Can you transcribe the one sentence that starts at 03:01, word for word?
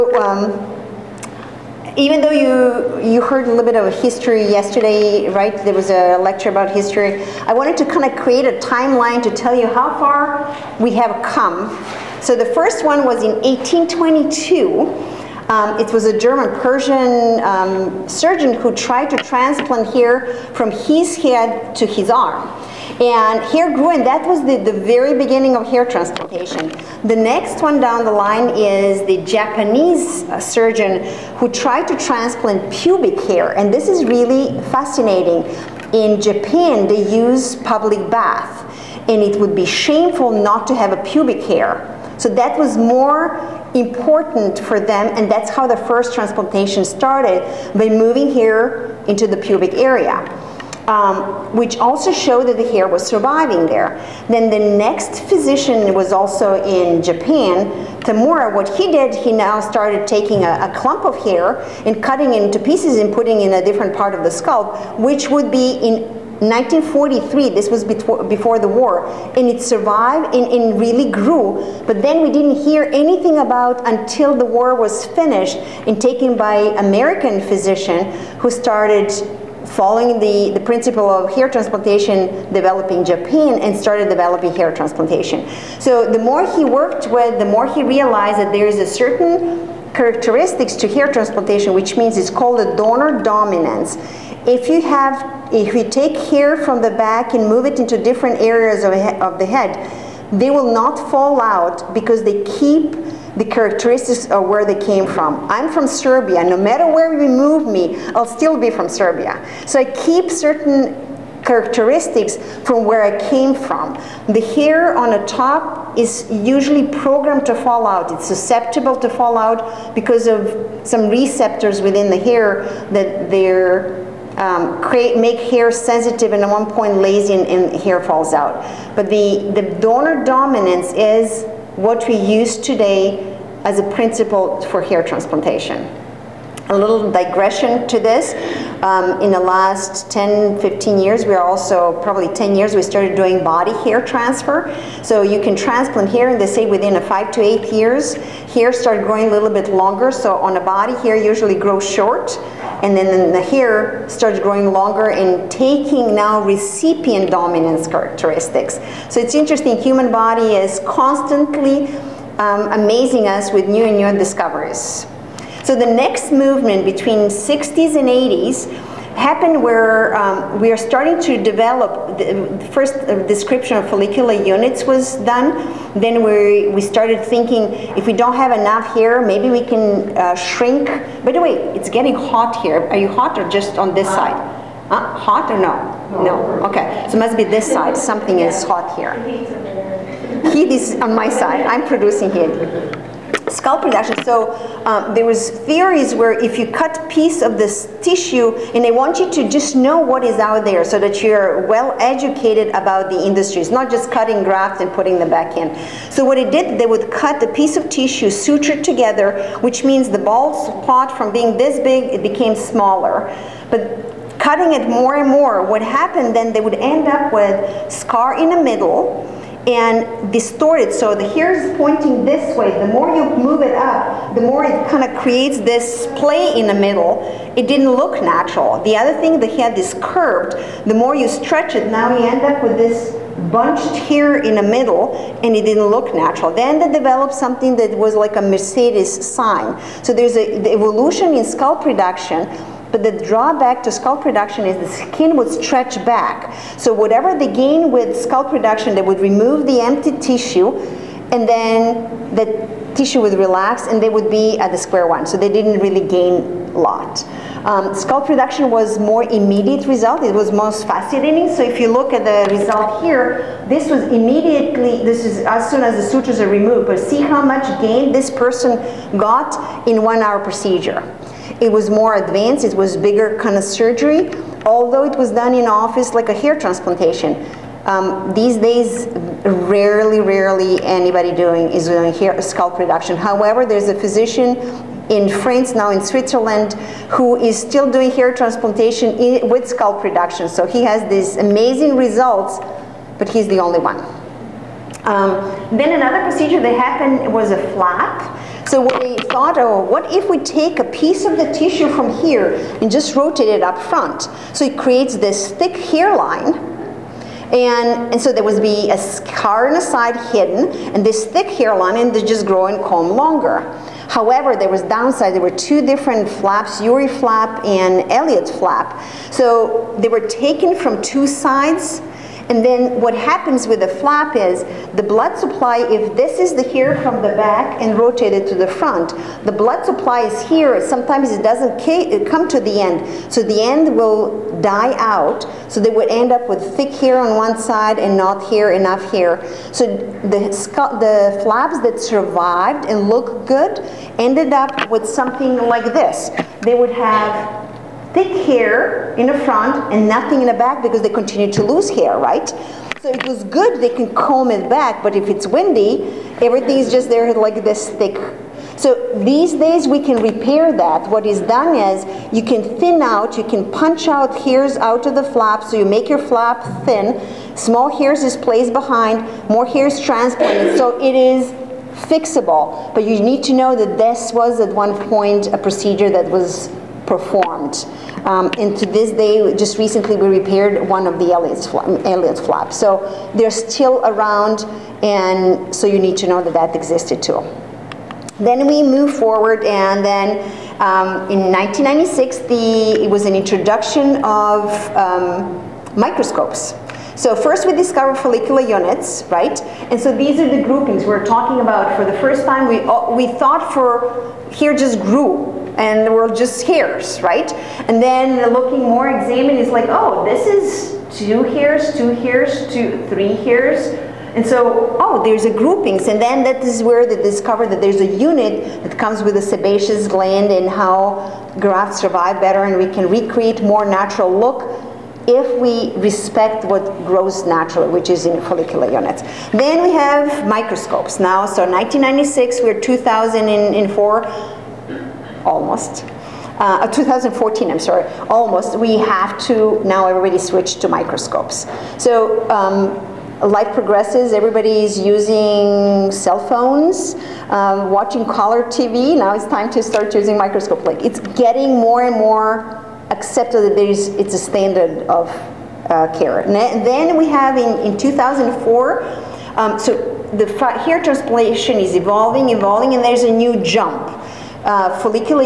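By the way, it's getting hot here.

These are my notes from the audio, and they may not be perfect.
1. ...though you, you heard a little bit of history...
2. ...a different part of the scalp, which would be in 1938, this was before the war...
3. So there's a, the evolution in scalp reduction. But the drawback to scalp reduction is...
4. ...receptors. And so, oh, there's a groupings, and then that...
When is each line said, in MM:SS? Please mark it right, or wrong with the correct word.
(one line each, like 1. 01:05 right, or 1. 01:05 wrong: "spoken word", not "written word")
1. 00:02 right
2. 01:03 wrong: "1943", not "1938"
3. 04:00 right
4. 06:53 wrong: "hears", not "receptors".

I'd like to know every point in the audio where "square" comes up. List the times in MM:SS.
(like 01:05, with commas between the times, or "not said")
04:14.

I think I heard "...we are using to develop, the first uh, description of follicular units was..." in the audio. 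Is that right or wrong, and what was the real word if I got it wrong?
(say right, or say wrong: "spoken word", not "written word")
wrong: "starting", not "using".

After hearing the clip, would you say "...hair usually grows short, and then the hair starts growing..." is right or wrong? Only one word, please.
right.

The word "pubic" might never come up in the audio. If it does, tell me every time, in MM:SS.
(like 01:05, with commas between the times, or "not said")
00:32, 00:41, 00:49.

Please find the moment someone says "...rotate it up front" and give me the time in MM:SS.
05:03.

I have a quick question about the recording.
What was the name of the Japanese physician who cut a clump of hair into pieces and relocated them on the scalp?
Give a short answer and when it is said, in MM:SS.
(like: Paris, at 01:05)
Tamura, at 00:58.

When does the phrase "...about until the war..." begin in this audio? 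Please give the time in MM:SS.
01:13.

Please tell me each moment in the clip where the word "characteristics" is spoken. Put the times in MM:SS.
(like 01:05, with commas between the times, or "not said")
01:29, 01:43, 01:51, 02:37.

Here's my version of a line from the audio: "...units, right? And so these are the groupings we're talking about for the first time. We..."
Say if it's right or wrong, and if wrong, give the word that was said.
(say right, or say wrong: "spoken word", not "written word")
right.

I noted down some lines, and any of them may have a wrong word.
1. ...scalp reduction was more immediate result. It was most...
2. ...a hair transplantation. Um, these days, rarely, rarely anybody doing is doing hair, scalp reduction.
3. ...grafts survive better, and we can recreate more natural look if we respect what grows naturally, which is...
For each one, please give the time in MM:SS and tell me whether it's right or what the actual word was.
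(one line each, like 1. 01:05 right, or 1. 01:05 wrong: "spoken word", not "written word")
1. 04:17 right
2. 04:36 right
3. 07:01 right.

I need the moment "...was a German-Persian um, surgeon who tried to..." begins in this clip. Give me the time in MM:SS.
00:15.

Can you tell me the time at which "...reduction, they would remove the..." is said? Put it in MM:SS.
04:08.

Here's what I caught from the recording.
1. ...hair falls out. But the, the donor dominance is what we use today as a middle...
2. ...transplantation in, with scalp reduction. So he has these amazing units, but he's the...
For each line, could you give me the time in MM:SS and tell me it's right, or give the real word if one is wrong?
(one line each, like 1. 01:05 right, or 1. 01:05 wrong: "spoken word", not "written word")
1. 02:07 wrong: "principle", not "middle"
2. 04:48 wrong: "results", not "units".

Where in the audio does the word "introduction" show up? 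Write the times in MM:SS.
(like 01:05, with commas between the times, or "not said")
06:33.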